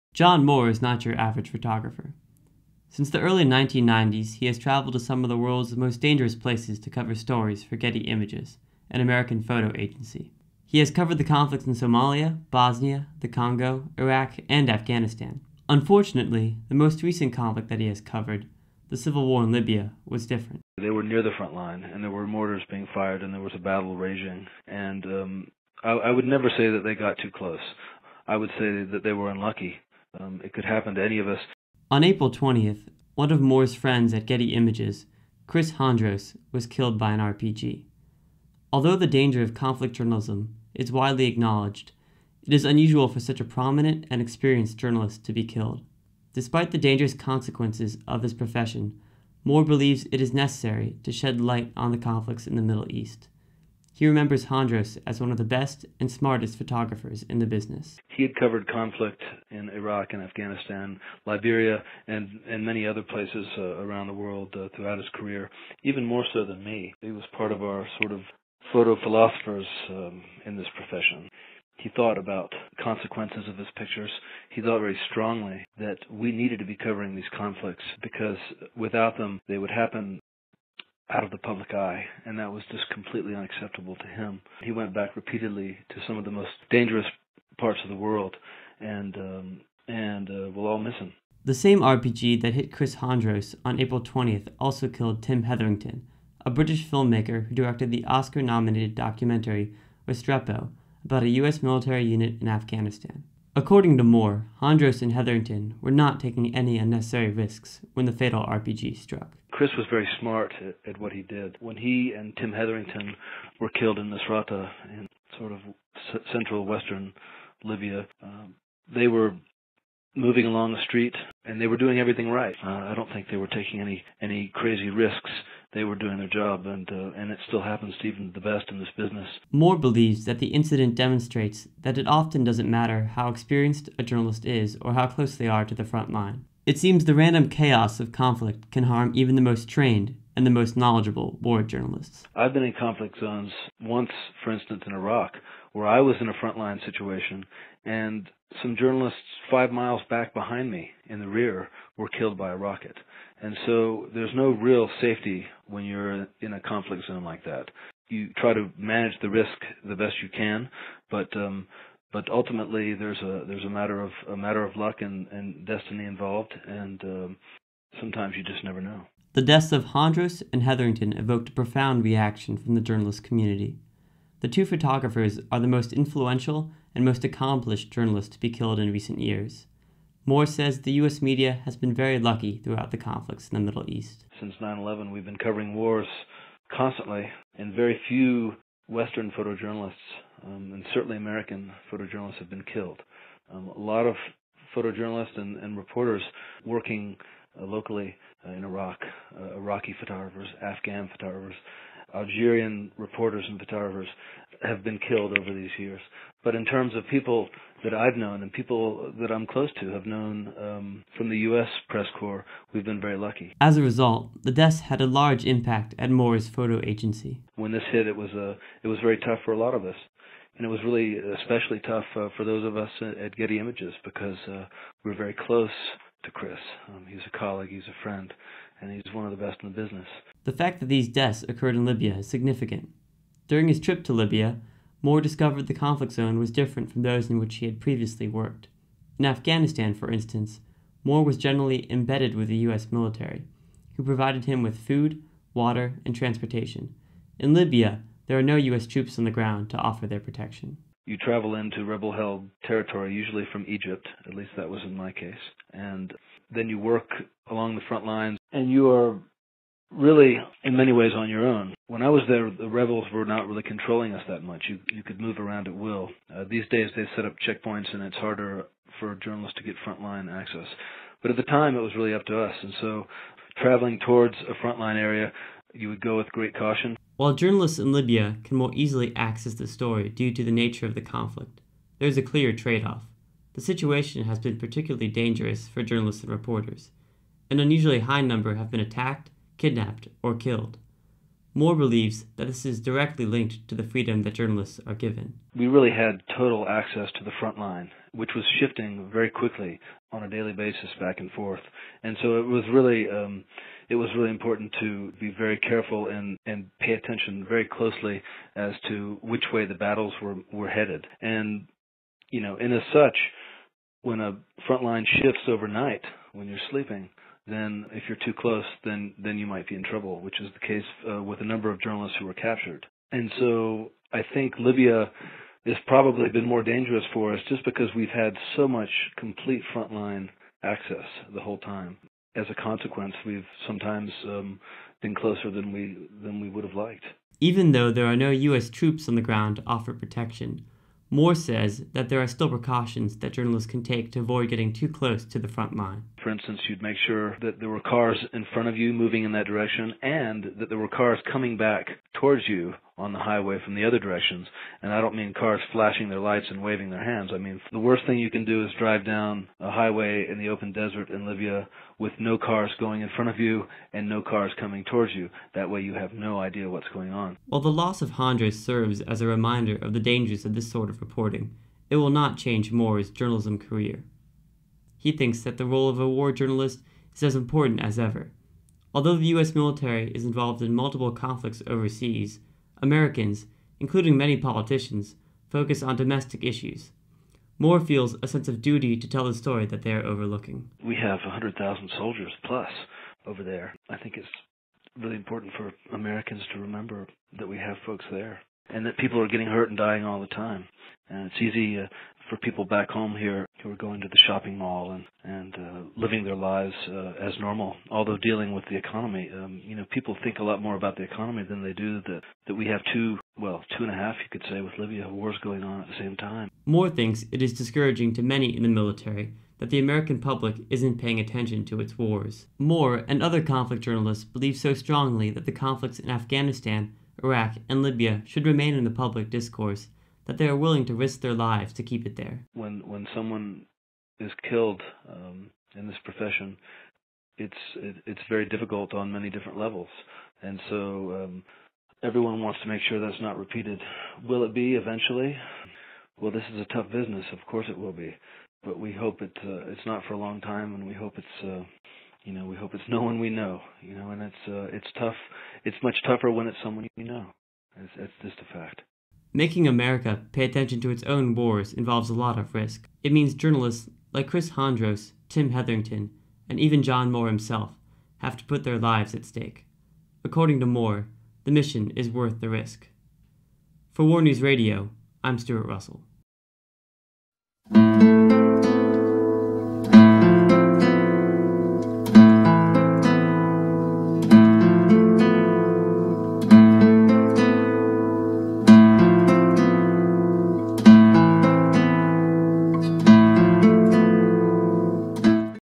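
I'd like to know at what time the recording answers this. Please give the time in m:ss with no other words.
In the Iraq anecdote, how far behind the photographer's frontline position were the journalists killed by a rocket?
2:29.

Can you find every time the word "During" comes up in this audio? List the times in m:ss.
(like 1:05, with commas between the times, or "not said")
3:53.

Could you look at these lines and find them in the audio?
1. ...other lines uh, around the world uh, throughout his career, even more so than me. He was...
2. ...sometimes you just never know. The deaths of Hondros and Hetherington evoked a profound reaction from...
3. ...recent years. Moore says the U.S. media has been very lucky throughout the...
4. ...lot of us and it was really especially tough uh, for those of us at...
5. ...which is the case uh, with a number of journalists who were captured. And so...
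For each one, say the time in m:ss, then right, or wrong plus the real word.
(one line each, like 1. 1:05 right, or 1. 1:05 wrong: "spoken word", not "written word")
1. 1:02 wrong: "places", not "lines"
2. 2:47 right
3. 2:58 right
4. 3:39 right
5. 5:20 right.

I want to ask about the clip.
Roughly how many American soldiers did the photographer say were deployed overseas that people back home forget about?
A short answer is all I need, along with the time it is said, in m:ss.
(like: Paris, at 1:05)
100,000, at 6:31.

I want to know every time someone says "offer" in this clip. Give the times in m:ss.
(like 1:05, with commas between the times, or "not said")
4:09, 5:39.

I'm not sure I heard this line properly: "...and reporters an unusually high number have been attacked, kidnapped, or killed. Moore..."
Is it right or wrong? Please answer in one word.
right.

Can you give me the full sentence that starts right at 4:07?
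In Libya, there are no U.S.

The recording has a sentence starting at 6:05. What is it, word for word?
That way you have no idea what's going on.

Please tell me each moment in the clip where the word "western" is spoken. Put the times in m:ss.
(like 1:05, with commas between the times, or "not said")
1:56, 3:08.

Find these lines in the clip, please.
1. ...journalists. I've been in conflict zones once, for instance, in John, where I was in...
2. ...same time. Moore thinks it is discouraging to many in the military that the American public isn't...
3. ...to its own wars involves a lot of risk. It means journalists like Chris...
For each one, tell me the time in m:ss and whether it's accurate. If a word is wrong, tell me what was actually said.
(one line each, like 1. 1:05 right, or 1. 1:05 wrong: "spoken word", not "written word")
1. 2:21 wrong: "Iraq", not "John"
2. 6:55 right
3. 7:40 right.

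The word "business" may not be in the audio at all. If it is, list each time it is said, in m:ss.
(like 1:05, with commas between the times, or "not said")
0:57, 2:08, 3:49, 7:26.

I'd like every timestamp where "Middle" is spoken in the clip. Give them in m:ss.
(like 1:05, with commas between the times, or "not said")
0:52, 3:03.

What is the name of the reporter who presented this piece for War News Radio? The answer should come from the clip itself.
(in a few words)
Stuart Russell.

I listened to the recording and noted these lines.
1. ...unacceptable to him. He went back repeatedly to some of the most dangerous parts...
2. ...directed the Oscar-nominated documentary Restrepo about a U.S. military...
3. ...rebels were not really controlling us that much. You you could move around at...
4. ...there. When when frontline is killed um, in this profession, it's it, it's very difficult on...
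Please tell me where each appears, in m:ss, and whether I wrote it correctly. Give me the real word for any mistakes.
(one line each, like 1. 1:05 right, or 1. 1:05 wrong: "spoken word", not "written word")
1. 1:23 right
2. 1:37 right
3. 4:22 right
4. 7:12 wrong: "someone", not "frontline".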